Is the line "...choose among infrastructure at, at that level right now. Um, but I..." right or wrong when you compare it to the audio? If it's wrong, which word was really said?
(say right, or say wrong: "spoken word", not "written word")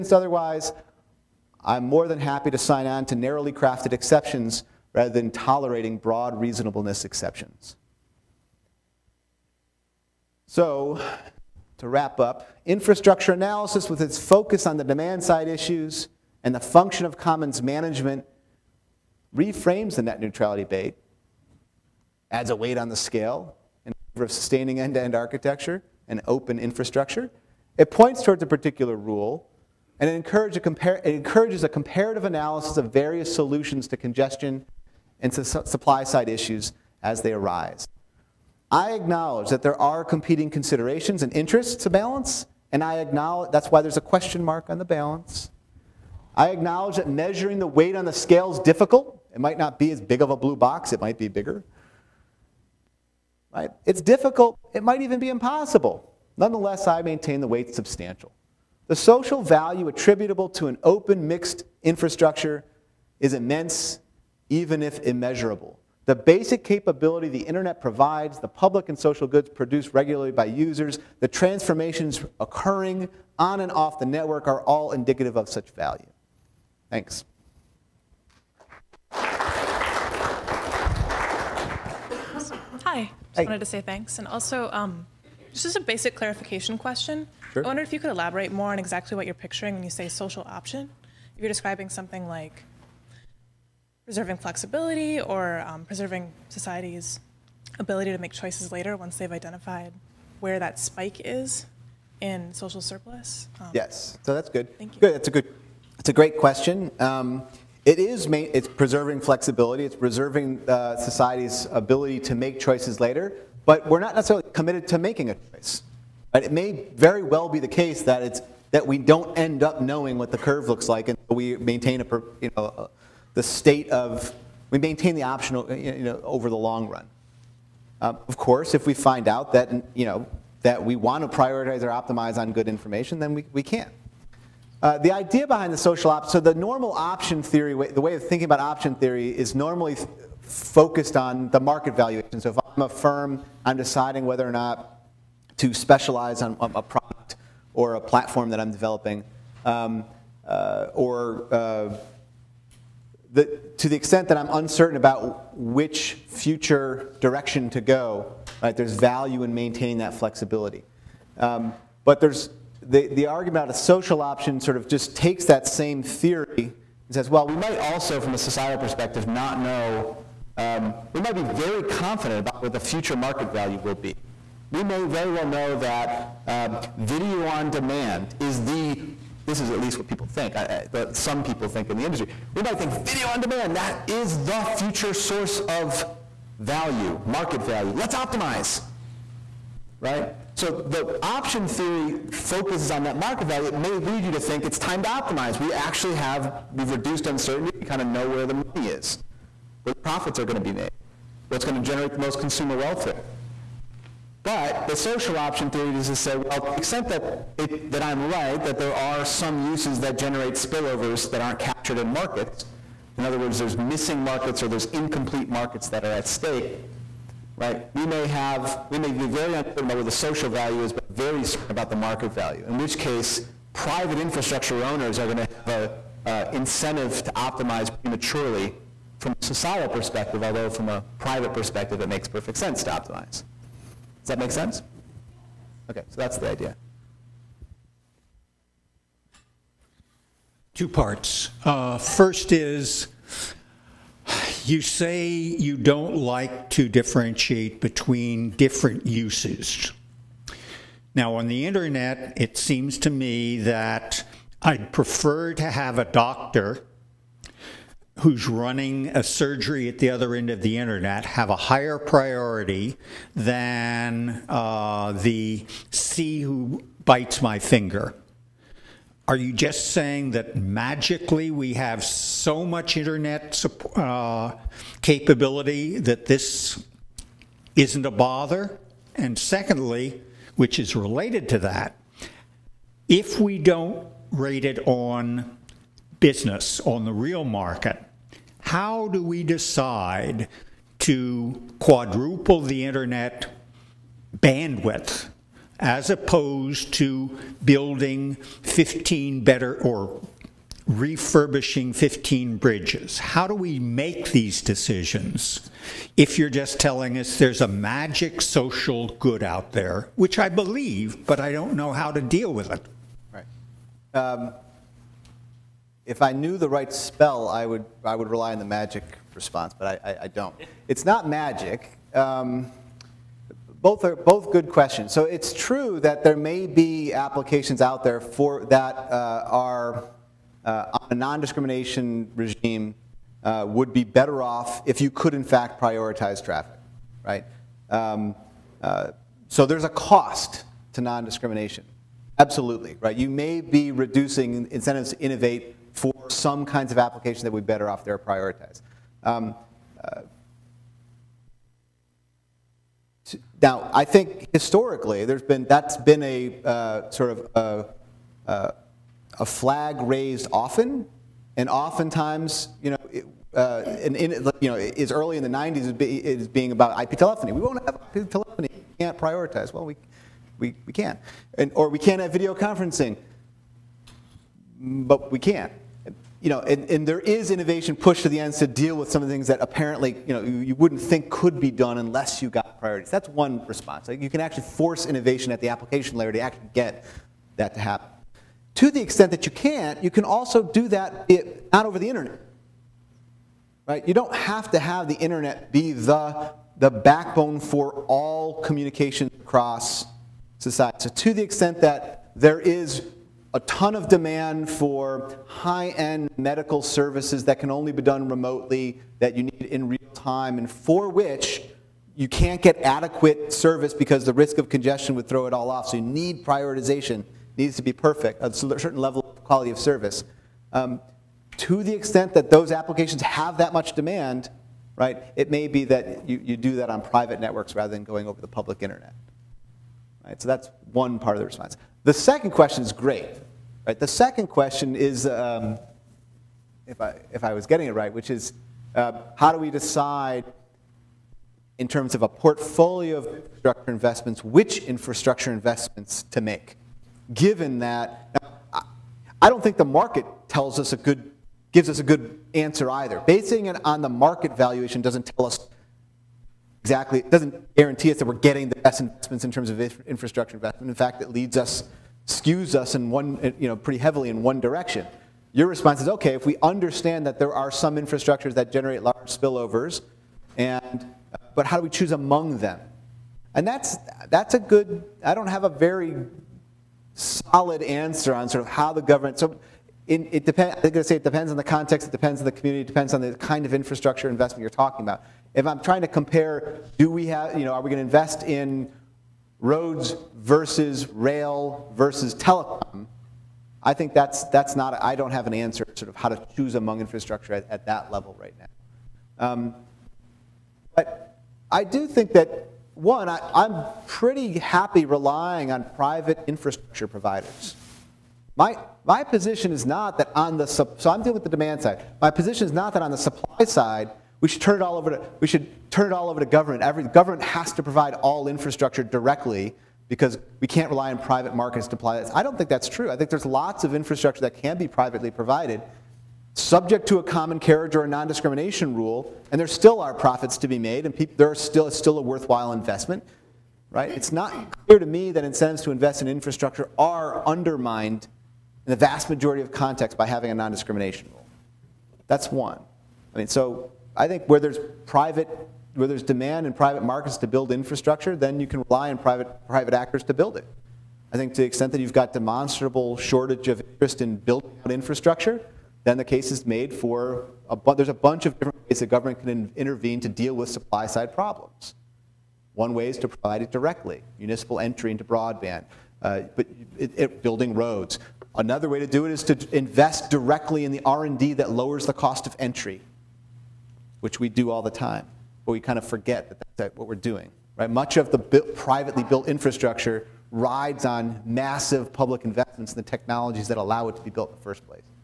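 right.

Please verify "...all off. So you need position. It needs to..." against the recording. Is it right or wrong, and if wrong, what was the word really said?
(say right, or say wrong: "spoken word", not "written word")
wrong: "prioritization", not "position".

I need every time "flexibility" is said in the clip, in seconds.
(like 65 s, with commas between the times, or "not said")
94 s, 109 s, 160 s.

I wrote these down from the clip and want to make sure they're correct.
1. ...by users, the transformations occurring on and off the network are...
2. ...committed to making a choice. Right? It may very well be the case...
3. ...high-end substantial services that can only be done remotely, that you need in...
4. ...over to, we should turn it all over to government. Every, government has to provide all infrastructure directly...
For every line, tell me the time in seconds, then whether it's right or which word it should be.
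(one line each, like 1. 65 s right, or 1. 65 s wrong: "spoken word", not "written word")
1. 70 s right
2. 114 s right
3. 405 s wrong: "medical", not "substantial"
4. 514 s right.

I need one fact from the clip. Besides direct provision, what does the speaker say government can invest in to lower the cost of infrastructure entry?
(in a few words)
R&D.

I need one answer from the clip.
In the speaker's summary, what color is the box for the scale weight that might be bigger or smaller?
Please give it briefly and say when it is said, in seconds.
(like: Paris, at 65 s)
Blue, at 50 s.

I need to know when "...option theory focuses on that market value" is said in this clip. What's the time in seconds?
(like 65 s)
191 s.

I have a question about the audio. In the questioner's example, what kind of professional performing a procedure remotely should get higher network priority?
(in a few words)
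A doctor.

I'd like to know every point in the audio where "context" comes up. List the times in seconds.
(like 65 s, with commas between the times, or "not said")
481 s, 539 s.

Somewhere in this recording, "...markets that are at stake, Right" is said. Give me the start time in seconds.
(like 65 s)
215 s.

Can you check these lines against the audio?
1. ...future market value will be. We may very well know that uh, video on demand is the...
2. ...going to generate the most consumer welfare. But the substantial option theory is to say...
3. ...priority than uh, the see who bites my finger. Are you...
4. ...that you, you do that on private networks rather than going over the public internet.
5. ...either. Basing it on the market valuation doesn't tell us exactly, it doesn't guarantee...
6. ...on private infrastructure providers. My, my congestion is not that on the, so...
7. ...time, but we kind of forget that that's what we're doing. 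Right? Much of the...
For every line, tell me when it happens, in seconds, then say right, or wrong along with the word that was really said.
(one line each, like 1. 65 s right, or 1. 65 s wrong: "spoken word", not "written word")
1. 172 s right
2. 201 s wrong: "social", not "substantial"
3. 261 s right
4. 425 s right
5. 452 s right
6. 505 s wrong: "position", not "congestion"
7. 574 s right.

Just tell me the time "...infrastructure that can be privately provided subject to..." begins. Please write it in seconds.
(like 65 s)
523 s.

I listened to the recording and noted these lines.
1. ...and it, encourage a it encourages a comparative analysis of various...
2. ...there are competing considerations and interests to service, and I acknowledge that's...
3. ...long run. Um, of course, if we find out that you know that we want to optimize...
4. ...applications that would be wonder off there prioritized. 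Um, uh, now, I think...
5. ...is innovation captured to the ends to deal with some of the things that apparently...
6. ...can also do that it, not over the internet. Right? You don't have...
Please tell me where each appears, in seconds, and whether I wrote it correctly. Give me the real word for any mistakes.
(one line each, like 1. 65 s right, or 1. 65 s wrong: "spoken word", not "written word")
1. 29 s right
2. 39 s wrong: "balance", not "service"
3. 126 s wrong: "prioritize", not "optimize"
4. 346 s wrong: "better", not "wonder"
5. 377 s wrong: "pushed", not "captured"
6. 390 s right.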